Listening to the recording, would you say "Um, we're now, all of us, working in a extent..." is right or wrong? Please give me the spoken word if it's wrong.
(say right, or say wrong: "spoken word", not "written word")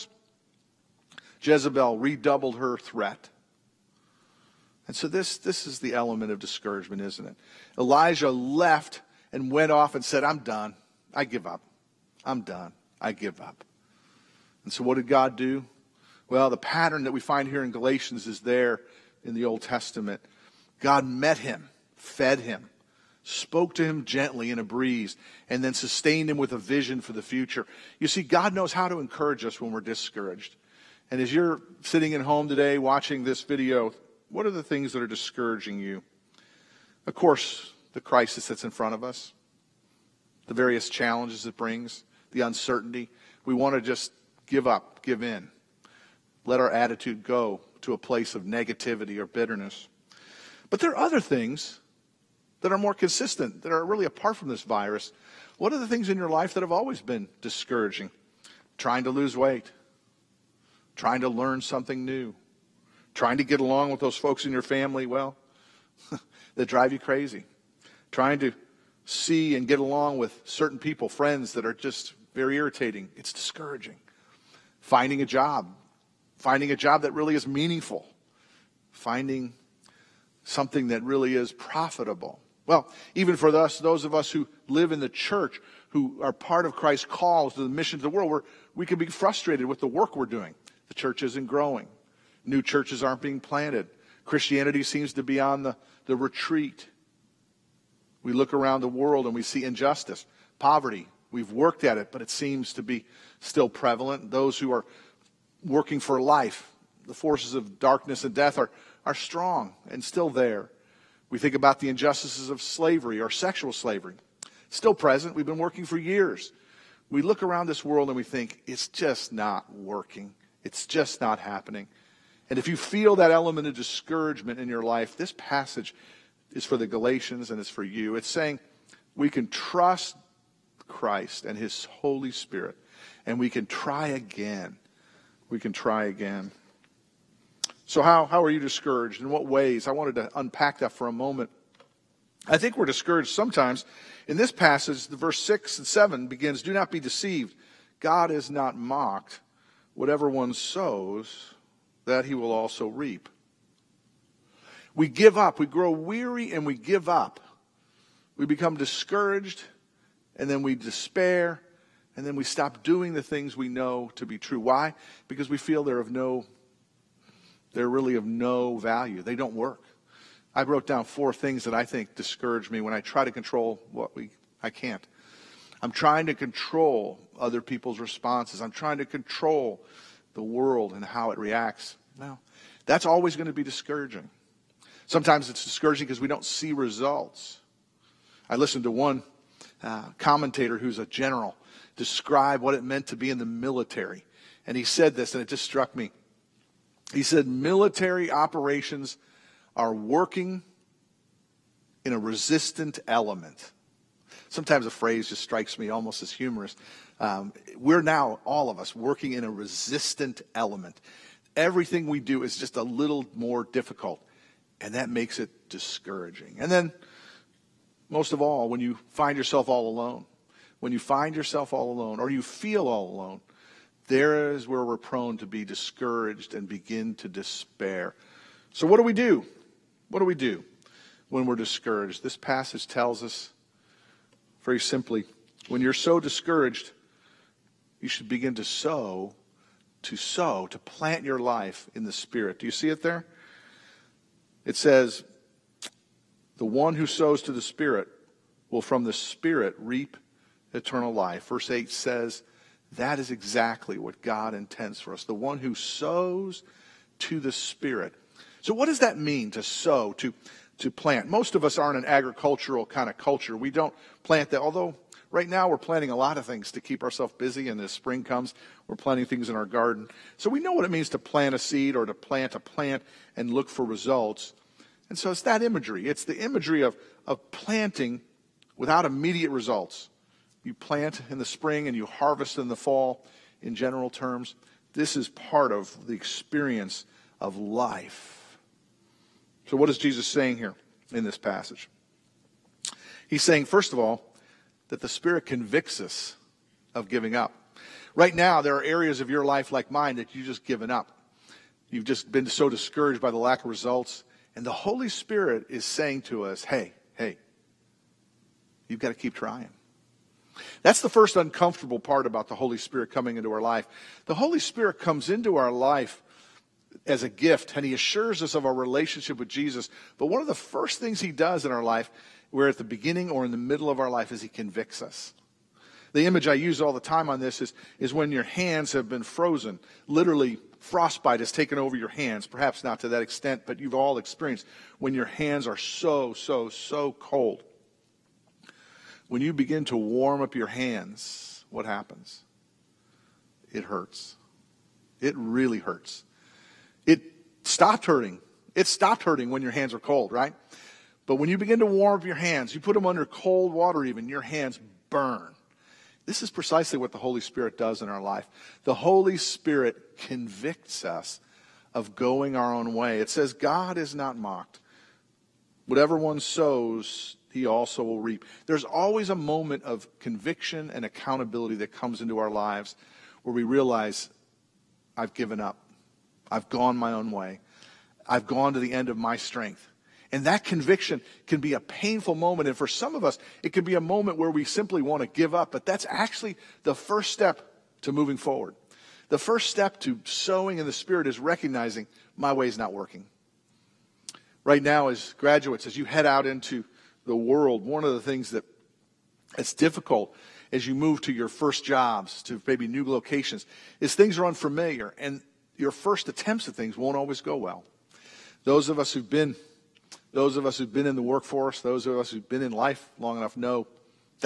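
wrong: "resistant", not "extent".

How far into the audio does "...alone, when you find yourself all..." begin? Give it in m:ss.
3:39.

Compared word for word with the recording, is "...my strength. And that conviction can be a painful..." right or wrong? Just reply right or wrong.
right.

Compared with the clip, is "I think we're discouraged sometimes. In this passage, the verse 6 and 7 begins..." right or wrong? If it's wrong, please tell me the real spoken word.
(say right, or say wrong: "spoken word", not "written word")
right.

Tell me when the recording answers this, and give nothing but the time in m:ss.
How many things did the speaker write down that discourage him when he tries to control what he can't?
2:51.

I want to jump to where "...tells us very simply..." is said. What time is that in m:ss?
3:52.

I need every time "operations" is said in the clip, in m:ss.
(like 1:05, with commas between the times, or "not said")
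3:18.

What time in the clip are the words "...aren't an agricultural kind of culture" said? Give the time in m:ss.
4:21.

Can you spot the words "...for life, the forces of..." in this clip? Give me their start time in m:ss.
1:45.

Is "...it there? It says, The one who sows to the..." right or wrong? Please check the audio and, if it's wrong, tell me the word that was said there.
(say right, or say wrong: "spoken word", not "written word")
right.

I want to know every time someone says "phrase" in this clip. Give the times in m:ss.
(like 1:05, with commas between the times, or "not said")
3:24.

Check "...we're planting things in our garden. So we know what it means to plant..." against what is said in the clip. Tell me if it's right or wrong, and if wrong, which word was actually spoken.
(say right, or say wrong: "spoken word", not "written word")
right.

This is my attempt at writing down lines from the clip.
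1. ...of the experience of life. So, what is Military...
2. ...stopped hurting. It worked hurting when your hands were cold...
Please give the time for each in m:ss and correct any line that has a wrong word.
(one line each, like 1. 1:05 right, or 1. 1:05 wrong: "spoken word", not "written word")
1. 4:45 wrong: "Jesus", not "Military"
2. 5:47 wrong: "stopped", not "worked".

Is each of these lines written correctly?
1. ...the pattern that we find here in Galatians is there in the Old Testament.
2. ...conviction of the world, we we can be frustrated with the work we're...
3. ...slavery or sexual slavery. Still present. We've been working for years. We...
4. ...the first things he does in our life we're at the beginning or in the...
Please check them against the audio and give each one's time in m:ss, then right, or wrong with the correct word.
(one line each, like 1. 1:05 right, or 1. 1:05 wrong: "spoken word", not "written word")
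1. 0:16 right
2. 1:27 wrong: "mission", not "conviction"
3. 1:52 right
4. 5:20 right.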